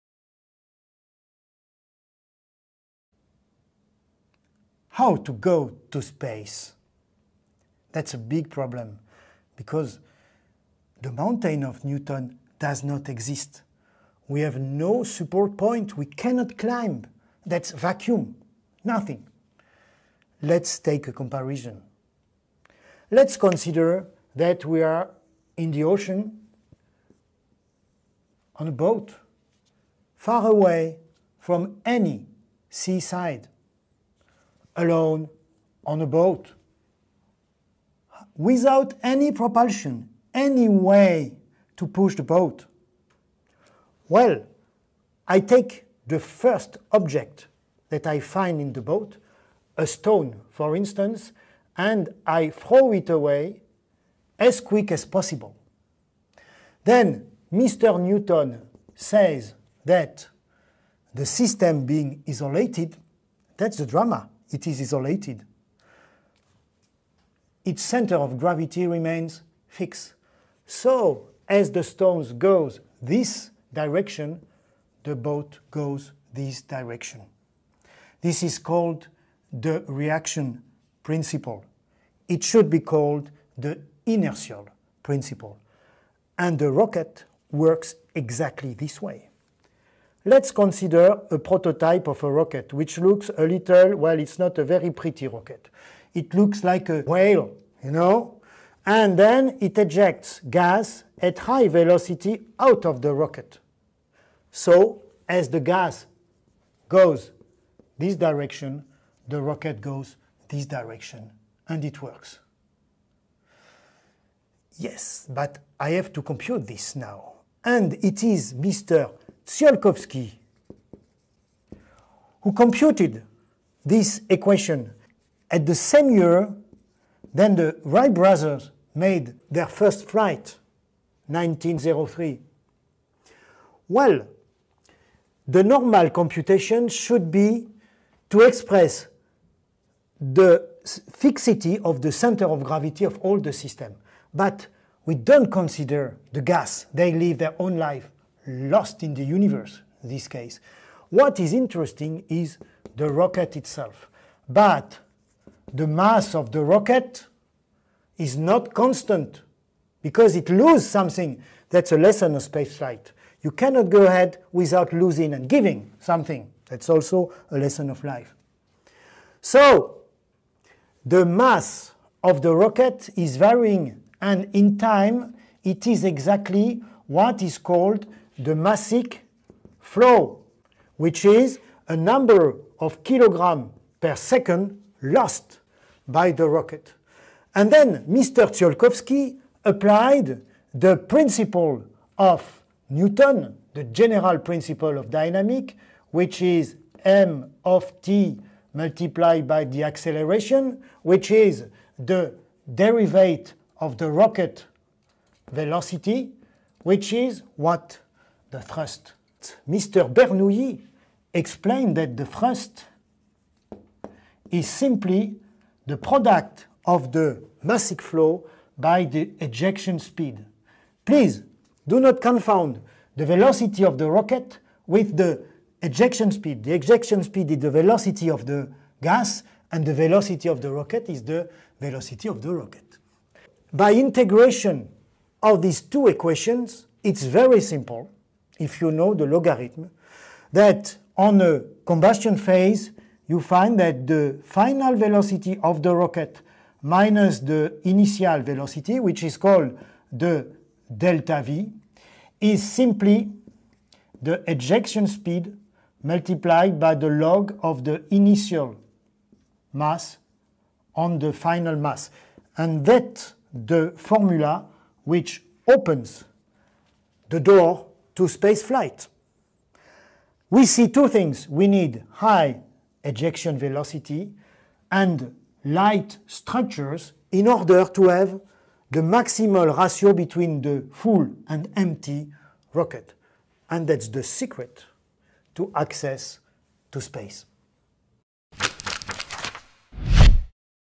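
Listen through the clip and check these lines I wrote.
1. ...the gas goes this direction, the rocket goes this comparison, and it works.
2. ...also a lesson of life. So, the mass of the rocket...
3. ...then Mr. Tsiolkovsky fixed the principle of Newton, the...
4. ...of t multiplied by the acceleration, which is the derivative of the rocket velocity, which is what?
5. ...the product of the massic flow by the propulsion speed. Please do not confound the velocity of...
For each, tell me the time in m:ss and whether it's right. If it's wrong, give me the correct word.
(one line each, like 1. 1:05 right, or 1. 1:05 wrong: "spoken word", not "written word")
1. 1:45 wrong: "direction", not "comparison"
2. 2:46 right
3. 3:07 wrong: "applied", not "fixed"
4. 3:17 right
5. 3:35 wrong: "ejection", not "propulsion".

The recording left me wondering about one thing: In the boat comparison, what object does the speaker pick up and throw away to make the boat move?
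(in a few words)
A stone.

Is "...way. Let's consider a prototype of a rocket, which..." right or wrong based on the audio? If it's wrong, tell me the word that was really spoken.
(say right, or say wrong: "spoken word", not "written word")
right.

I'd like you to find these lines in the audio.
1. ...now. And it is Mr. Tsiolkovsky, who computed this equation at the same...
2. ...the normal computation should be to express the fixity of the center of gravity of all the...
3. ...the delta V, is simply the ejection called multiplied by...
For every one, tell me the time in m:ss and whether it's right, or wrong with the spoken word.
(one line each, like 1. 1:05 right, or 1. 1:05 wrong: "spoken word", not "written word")
1. 1:56 right
2. 2:15 right
3. 4:10 wrong: "speed", not "called".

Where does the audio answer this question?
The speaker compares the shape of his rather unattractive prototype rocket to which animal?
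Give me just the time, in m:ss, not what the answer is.
1:36.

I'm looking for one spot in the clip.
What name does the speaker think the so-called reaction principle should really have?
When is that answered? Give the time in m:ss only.
1:23.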